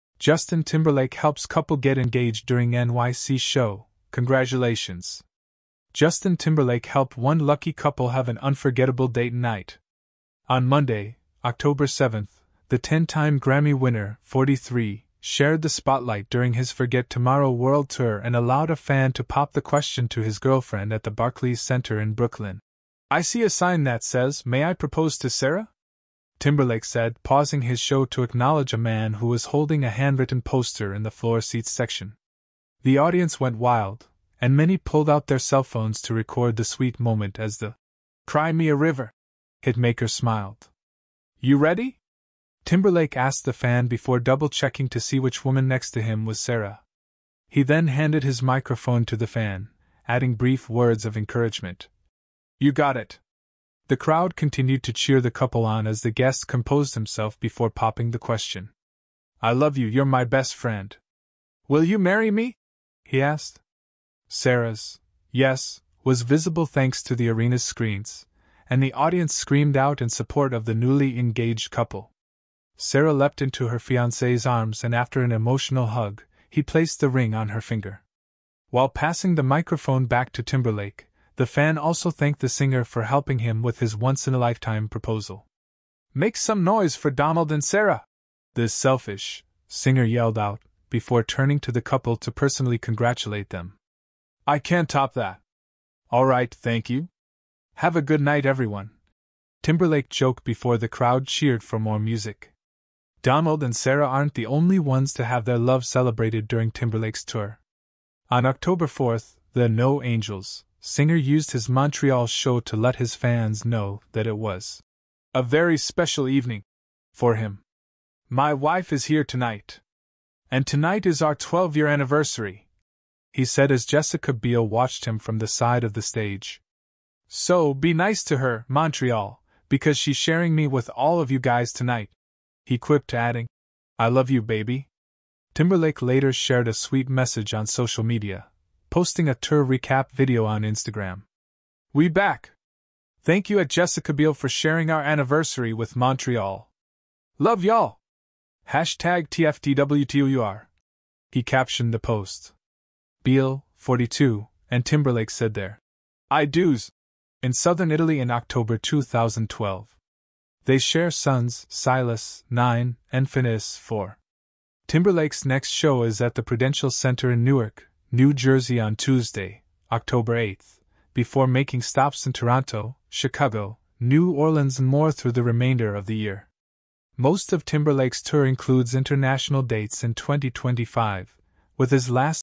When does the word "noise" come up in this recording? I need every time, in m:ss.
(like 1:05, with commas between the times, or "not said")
1:26.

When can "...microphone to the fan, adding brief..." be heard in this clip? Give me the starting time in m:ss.
0:48.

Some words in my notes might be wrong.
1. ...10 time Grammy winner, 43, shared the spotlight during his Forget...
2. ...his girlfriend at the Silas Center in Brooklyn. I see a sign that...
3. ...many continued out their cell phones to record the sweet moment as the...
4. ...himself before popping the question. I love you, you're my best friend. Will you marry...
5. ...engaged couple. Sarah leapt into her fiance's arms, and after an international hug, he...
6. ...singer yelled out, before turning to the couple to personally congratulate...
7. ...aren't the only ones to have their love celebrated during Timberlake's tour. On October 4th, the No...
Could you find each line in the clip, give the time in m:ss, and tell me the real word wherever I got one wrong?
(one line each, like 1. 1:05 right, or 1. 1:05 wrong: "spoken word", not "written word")
1. 0:12 right
2. 0:20 wrong: "Barclays", not "Silas"
3. 0:34 wrong: "pulled", not "continued"
4. 0:56 right
5. 1:11 wrong: "emotional", not "international"
6. 1:29 right
7. 1:44 right.